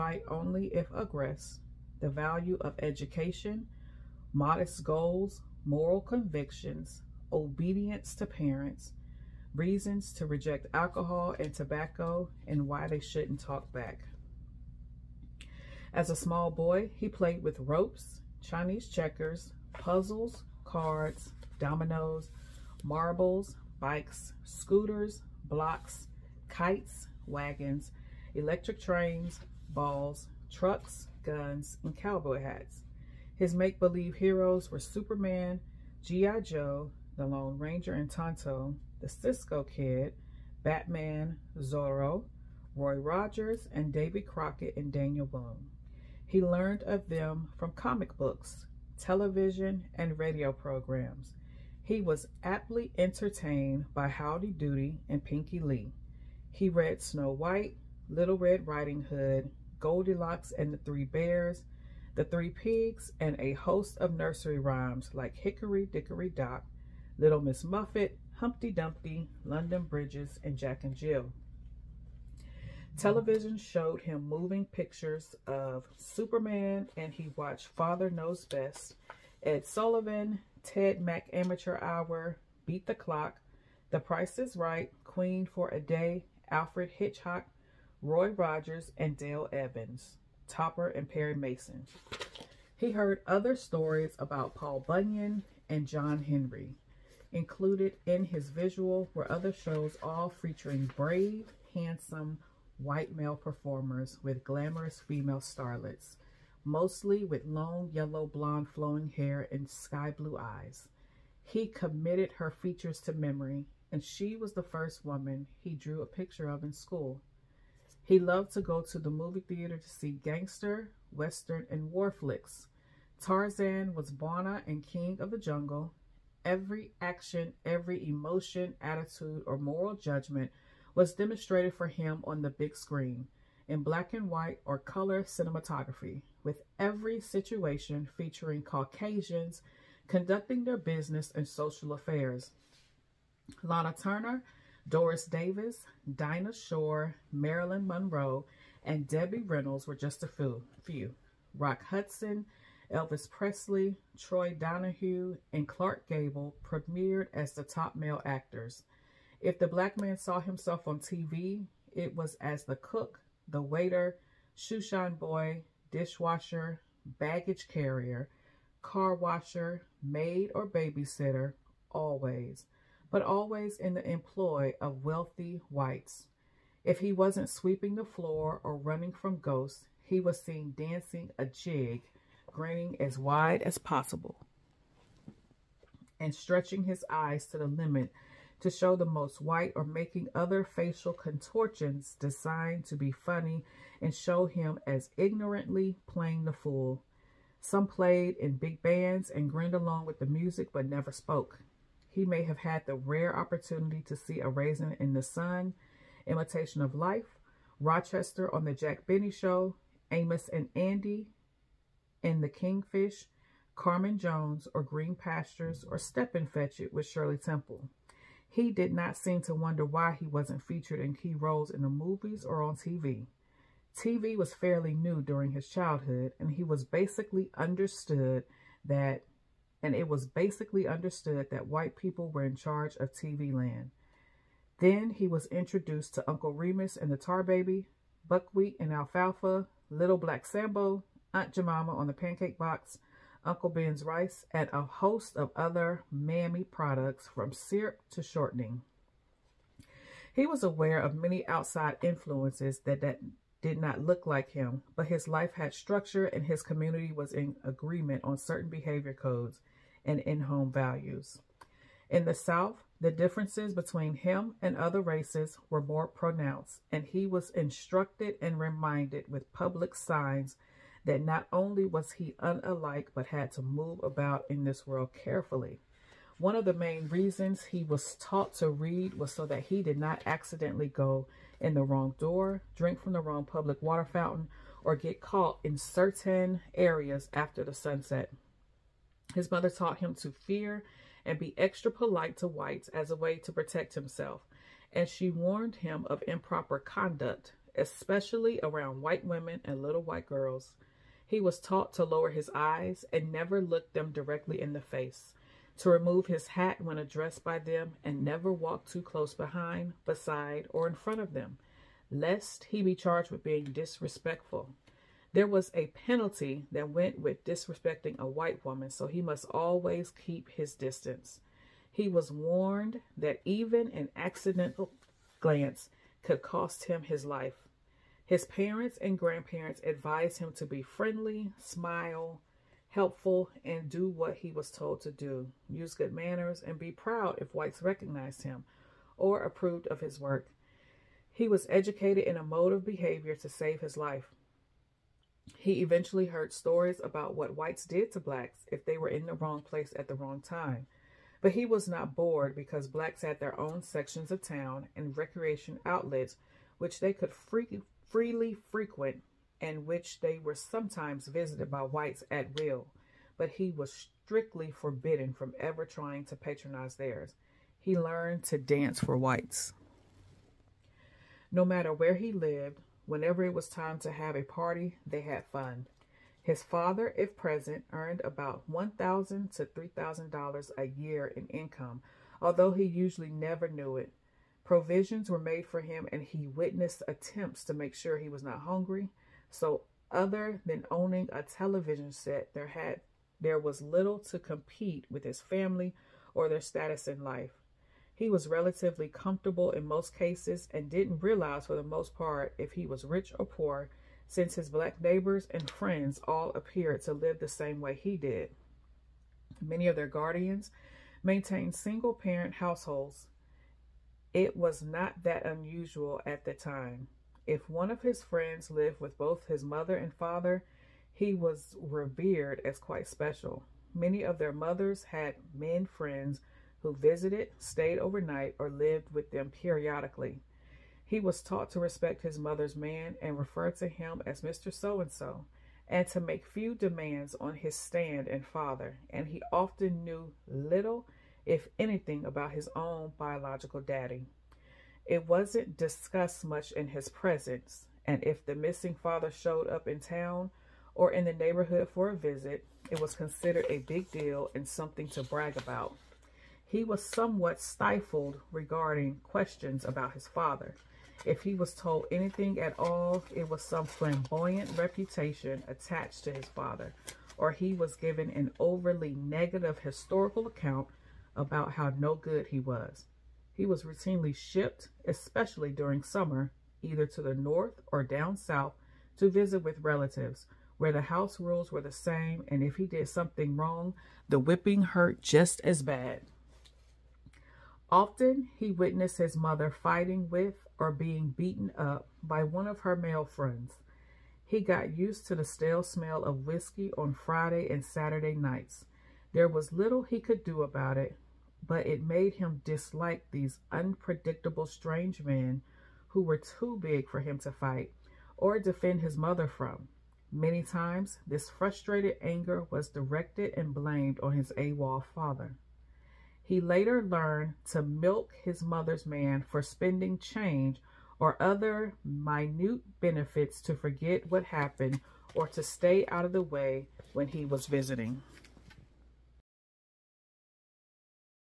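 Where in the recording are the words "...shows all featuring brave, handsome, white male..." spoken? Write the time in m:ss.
1:39.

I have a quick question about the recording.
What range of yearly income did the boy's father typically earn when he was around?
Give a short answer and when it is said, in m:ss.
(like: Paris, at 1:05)
$1,000 to $3,000, at 6:18.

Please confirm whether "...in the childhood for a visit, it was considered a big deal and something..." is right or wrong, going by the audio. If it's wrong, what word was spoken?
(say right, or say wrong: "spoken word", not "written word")
wrong: "neighborhood", not "childhood".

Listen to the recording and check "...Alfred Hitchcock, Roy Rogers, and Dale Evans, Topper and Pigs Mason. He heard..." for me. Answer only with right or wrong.
wrong.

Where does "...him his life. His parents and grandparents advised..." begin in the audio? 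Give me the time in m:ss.
5:26.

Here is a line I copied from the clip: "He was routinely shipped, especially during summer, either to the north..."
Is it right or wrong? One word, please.
right.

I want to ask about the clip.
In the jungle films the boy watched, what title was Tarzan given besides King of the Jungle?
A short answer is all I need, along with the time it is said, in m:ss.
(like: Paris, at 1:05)
Bwana, at 2:04.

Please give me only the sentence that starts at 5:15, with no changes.
There was a penalty that went with disrespecting a white woman, so he must always keep his distance.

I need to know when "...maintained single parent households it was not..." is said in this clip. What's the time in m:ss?
6:51.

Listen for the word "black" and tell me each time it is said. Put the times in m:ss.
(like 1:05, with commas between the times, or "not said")
2:13, 2:39, 4:00, 5:48, 5:52, 6:44.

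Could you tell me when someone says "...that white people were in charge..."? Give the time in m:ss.
3:51.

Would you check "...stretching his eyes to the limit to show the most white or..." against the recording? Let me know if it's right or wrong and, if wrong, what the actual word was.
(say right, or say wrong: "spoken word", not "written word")
right.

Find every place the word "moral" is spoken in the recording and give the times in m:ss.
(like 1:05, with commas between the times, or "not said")
0:05, 2:09.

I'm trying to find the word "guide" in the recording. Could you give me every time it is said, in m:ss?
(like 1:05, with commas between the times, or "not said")
not said.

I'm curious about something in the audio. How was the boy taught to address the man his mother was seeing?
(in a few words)
Mr. So and so.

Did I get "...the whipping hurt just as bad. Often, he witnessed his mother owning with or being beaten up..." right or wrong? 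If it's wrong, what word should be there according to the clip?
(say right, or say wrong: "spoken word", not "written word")
wrong: "fighting", not "owning".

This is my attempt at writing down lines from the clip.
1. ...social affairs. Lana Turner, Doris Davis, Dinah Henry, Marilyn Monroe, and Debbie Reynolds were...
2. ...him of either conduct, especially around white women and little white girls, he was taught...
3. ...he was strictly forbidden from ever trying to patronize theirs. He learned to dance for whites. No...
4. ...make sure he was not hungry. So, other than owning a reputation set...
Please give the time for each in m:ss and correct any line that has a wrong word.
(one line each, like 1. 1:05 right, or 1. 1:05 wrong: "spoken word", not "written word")
1. 2:21 wrong: "Shore", not "Henry"
2. 4:55 wrong: "improper", not "either"
3. 6:03 right
4. 6:27 wrong: "television", not "reputation".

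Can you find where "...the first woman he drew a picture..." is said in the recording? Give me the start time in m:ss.
1:54.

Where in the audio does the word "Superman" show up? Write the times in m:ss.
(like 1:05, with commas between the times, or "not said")
0:34, 1:15.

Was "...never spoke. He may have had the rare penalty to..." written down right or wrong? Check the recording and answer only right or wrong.
wrong.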